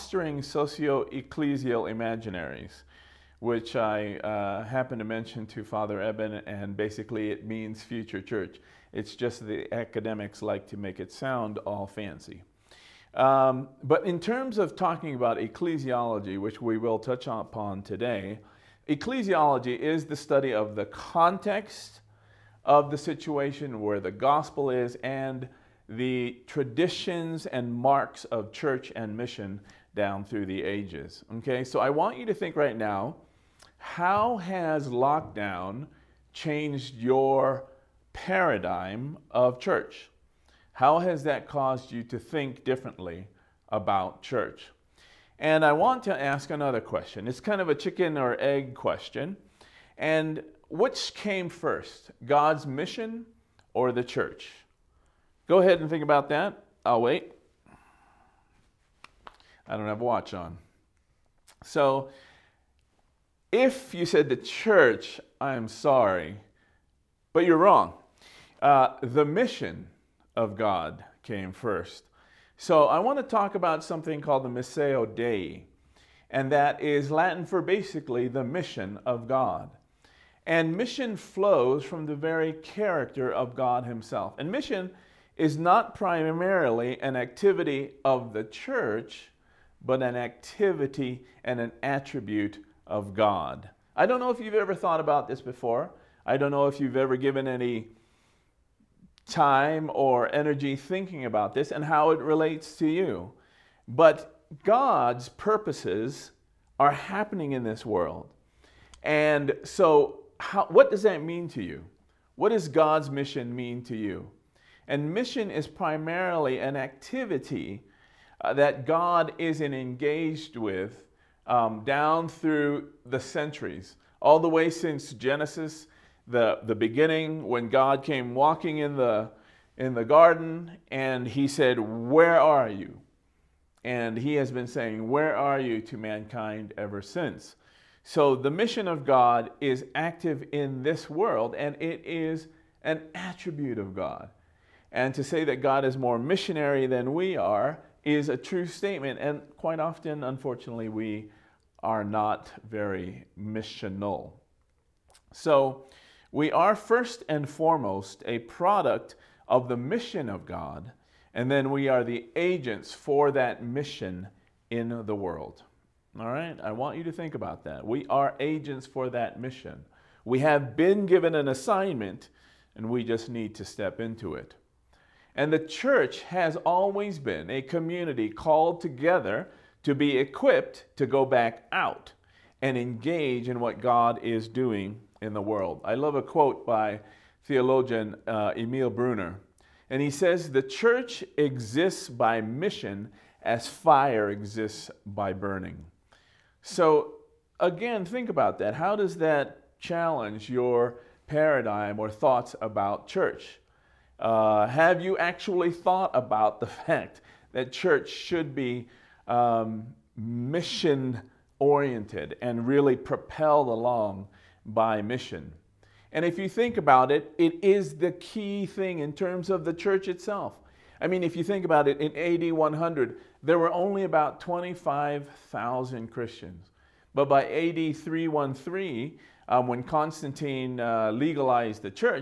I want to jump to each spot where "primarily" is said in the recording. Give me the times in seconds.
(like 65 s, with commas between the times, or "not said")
85 s, 115 s.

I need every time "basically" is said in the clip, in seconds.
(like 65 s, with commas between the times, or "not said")
6 s, 77 s.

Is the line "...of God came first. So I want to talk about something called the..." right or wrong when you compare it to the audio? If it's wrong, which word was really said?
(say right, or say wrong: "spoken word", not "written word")
right.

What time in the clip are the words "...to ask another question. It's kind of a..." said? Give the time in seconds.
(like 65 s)
46 s.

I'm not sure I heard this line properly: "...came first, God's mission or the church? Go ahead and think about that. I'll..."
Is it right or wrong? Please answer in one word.
right.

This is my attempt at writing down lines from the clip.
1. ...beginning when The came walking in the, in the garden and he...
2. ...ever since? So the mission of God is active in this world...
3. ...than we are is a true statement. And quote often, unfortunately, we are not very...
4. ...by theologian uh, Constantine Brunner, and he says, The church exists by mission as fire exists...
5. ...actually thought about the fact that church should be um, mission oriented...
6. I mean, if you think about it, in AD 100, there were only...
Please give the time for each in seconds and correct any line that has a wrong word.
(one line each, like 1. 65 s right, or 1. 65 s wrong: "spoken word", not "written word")
1. 126 s wrong: "God", not "The"
2. 136 s right
3. 146 s wrong: "quite", not "quote"
4. 186 s wrong: "Emil", not "Constantine"
5. 205 s right
6. 221 s right.